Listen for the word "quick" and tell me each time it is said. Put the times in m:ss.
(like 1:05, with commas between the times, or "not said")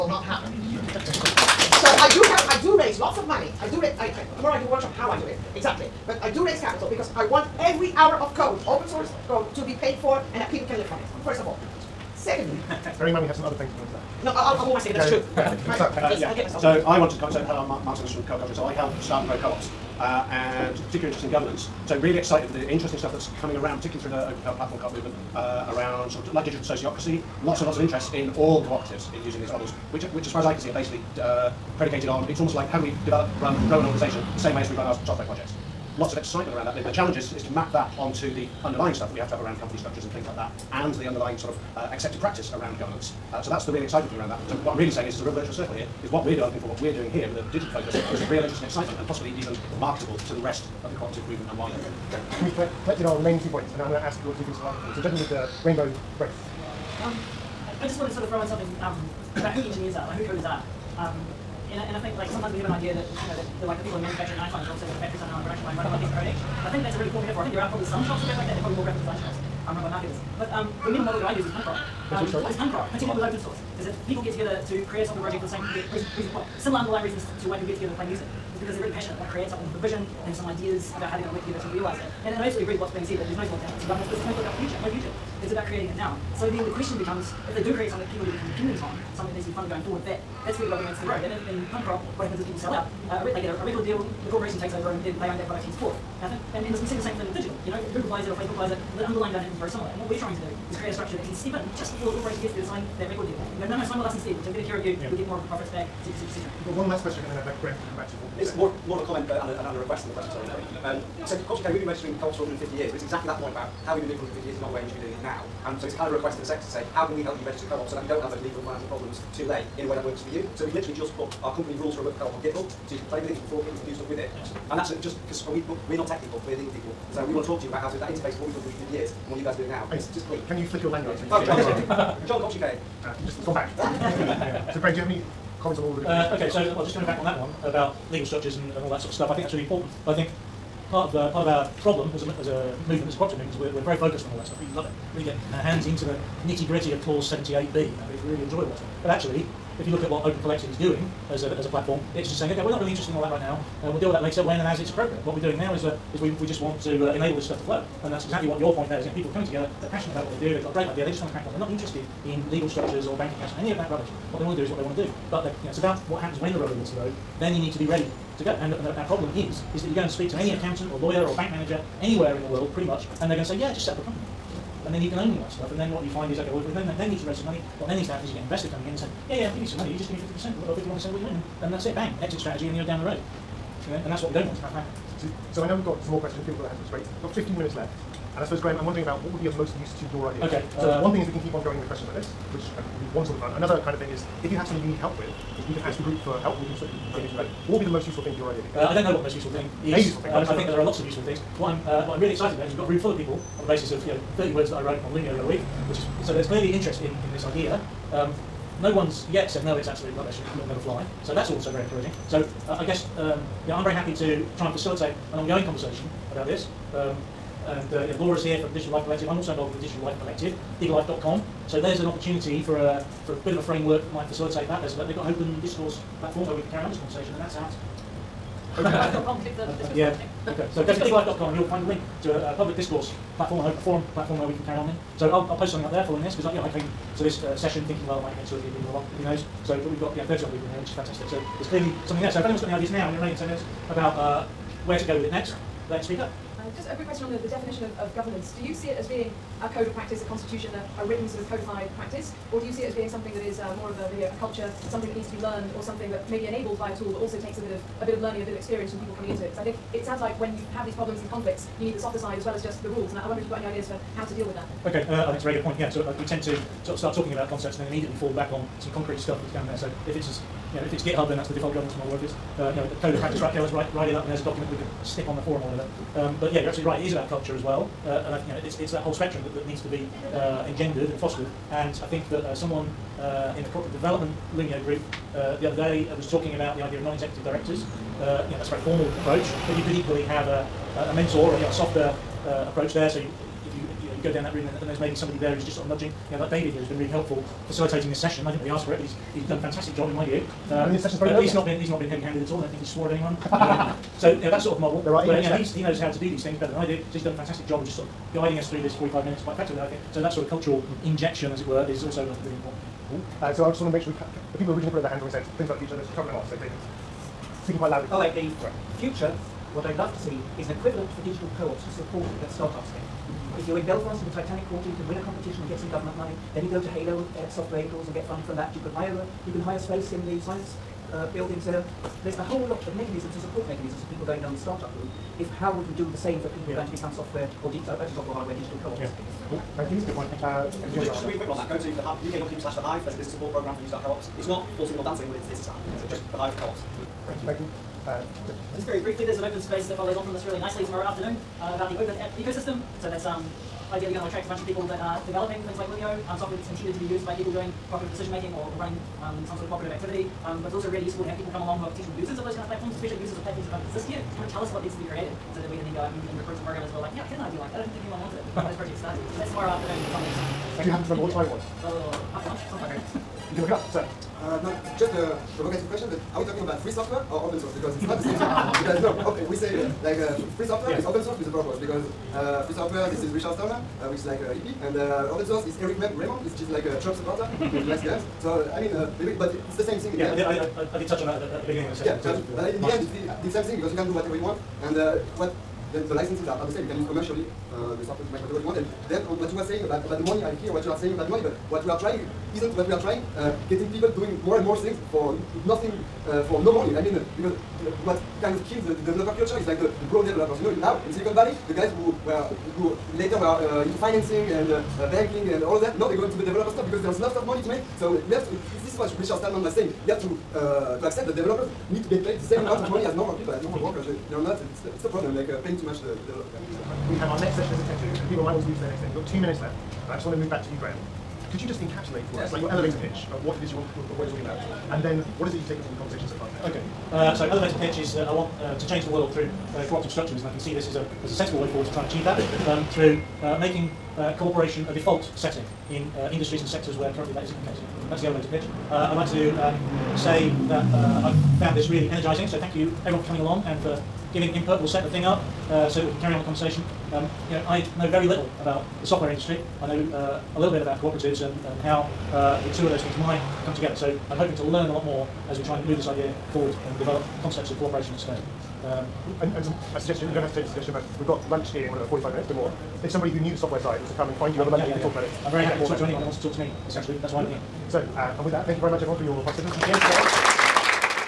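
4:06, 5:41.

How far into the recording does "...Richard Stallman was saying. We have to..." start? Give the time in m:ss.
6:59.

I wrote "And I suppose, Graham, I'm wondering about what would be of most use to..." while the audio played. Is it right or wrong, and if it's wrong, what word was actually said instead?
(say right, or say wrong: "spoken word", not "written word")
right.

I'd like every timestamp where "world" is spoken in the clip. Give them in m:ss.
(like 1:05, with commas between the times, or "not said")
2:52, 7:19.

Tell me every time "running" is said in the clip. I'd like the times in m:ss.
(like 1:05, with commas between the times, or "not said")
1:05, 5:58.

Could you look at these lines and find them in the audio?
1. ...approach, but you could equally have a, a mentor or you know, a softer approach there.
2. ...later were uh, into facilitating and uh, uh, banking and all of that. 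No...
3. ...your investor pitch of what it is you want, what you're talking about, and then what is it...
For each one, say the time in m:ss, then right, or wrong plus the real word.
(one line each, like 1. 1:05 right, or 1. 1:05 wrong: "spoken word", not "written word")
1. 4:49 right
2. 6:53 wrong: "financing", not "facilitating"
3. 7:12 wrong: "elevator", not "investor".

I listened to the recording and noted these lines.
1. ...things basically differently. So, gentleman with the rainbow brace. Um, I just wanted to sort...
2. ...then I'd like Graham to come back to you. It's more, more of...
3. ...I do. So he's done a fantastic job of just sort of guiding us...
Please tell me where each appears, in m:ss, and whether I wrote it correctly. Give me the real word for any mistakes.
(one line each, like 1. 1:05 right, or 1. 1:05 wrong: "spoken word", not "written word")
1. 0:54 wrong: "slightly", not "basically"
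2. 1:47 right
3. 5:06 right.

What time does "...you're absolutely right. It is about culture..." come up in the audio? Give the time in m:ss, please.
4:36.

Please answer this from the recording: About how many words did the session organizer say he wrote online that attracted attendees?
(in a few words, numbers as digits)
30.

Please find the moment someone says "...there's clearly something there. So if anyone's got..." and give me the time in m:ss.
4:01.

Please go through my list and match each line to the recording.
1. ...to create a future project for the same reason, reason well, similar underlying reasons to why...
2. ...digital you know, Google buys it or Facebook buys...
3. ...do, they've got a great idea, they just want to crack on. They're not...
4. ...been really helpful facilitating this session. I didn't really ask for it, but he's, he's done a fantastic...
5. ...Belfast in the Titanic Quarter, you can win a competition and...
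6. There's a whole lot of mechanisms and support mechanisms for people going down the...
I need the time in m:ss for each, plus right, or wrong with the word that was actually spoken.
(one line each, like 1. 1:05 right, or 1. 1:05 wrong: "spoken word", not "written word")
1. 1:14 wrong: "software", not "future"
2. 1:37 right
3. 2:40 right
4. 4:56 right
5. 5:23 right
6. 5:32 right.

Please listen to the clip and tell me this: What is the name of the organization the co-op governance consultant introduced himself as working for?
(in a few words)
Co-op Culture.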